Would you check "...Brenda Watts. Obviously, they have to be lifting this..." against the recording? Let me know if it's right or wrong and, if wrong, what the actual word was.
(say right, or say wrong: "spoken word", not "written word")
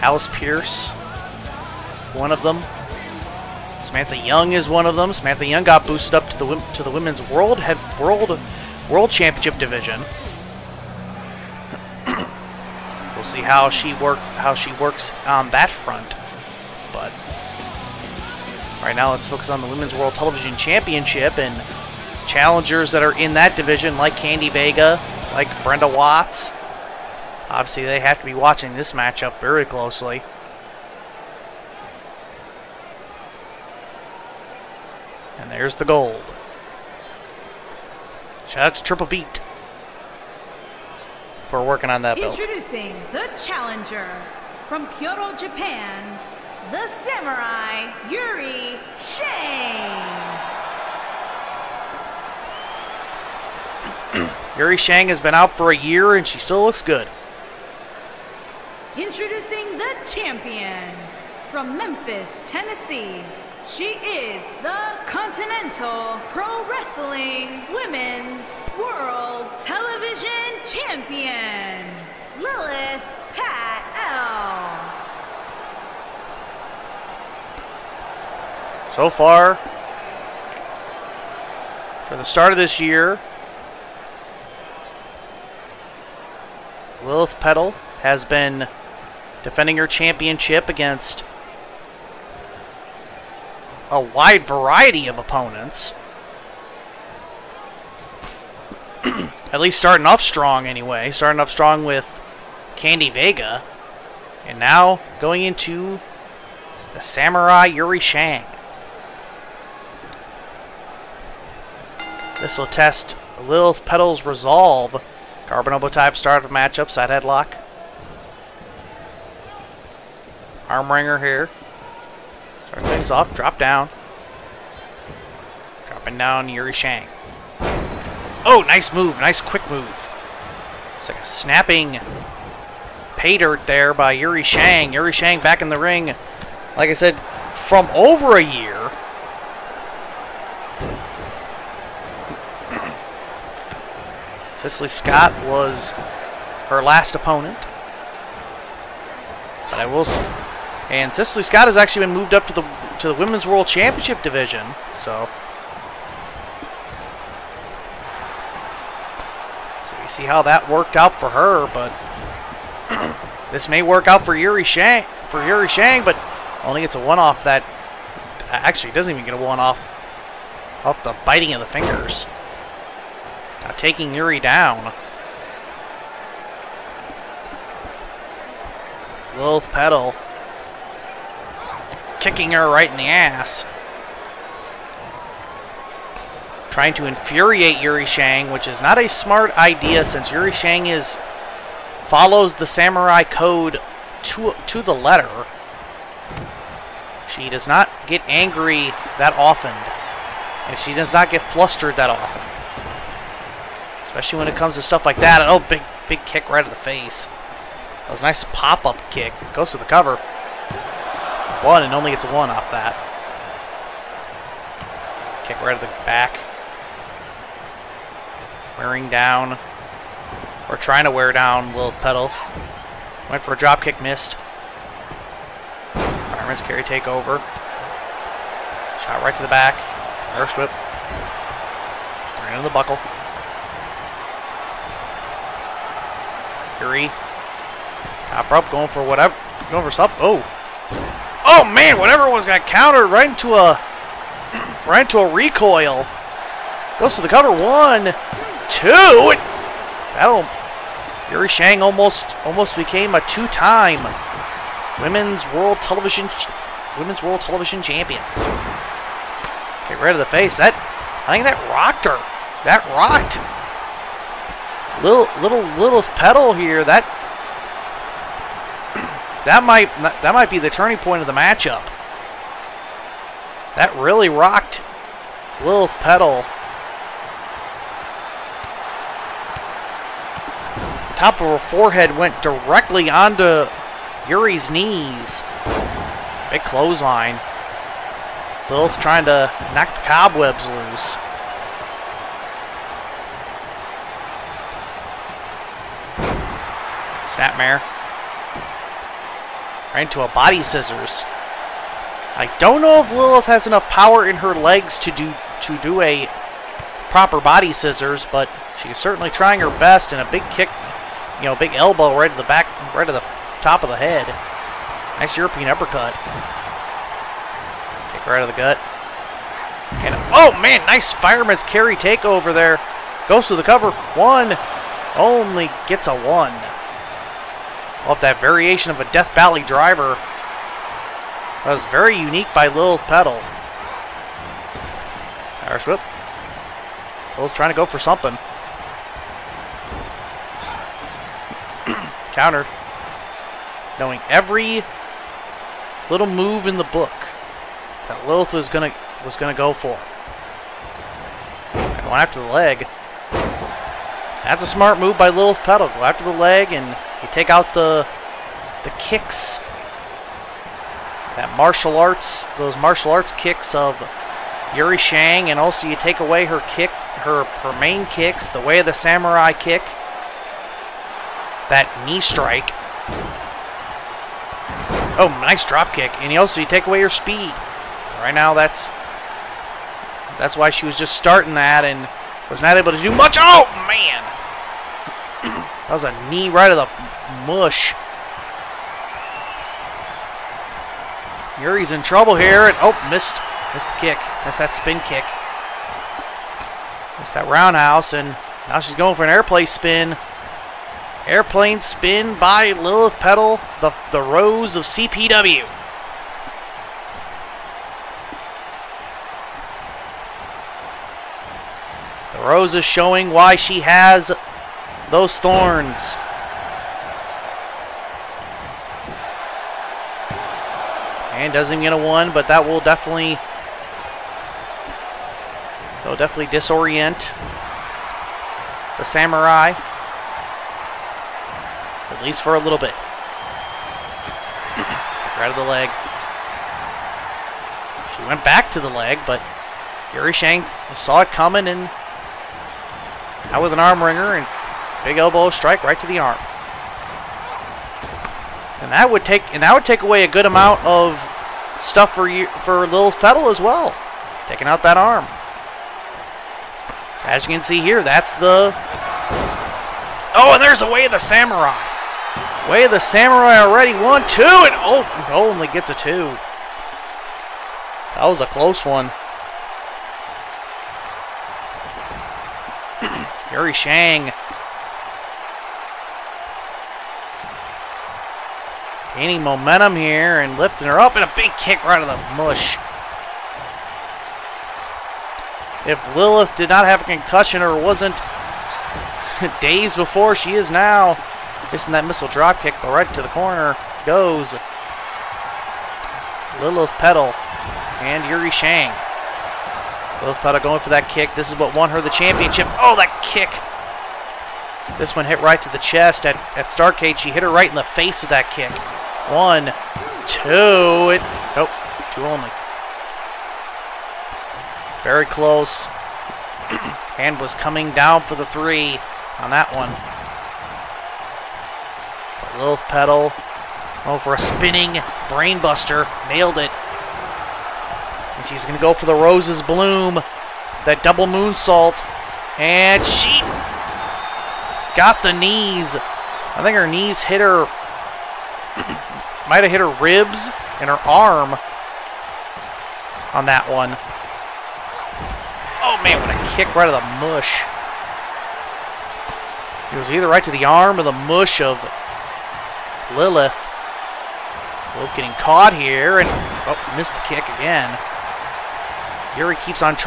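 wrong: "watching", not "lifting".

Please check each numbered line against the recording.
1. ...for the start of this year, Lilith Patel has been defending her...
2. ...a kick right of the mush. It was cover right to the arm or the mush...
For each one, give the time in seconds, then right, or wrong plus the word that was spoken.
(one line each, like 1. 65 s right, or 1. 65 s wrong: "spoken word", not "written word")
1. 82 s right
2. 546 s wrong: "either", not "cover".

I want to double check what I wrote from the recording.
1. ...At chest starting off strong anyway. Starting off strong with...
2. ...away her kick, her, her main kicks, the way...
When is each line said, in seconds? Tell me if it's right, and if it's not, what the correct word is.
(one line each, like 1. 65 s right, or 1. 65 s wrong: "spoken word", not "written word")
1. 99 s wrong: "least", not "chest"
2. 366 s right.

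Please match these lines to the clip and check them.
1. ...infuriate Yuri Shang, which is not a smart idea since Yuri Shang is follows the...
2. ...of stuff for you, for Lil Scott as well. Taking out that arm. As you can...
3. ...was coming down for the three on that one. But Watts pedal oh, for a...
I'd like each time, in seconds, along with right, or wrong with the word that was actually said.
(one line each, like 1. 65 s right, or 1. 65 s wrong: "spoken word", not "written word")
1. 187 s right
2. 450 s wrong: "Patel", not "Scott"
3. 517 s wrong: "Lilith", not "Watts".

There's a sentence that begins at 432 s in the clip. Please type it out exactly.
At least for a little bit.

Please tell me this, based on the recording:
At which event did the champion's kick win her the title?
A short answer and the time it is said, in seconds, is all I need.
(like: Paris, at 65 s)
Starcade, at 506 s.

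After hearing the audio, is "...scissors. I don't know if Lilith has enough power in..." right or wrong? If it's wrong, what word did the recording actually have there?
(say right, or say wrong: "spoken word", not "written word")
right.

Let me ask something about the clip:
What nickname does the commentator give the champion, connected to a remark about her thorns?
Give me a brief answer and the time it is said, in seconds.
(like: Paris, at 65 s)
The Rose of CPW, at 404 s.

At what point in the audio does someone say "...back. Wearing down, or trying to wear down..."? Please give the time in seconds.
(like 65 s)
216 s.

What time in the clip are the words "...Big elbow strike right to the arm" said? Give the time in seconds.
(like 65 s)
445 s.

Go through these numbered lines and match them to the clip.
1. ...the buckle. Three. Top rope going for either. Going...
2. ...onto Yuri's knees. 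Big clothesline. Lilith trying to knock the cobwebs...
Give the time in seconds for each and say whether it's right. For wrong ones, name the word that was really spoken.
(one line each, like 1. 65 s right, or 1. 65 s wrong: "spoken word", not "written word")
1. 232 s wrong: "whatever", not "either"
2. 283 s right.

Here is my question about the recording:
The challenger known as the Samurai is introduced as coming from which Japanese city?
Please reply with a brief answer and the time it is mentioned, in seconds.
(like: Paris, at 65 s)
Kyoto, at 44 s.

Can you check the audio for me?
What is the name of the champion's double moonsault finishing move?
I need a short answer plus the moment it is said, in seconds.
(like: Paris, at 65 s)
Roses Bloom, at 529 s.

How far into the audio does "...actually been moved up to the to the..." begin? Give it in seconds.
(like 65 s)
151 s.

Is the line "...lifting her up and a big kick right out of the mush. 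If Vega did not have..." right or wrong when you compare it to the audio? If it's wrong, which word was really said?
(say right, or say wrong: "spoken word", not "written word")
wrong: "Lilith", not "Vega".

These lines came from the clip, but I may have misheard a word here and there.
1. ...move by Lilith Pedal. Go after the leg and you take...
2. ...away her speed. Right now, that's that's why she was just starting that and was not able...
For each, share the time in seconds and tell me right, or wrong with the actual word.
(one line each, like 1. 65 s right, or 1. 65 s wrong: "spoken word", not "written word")
1. 354 s wrong: "Patel", not "Pedal"
2. 376 s right.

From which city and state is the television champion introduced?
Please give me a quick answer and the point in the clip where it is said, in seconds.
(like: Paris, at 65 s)
Memphis, Tennessee, at 61 s.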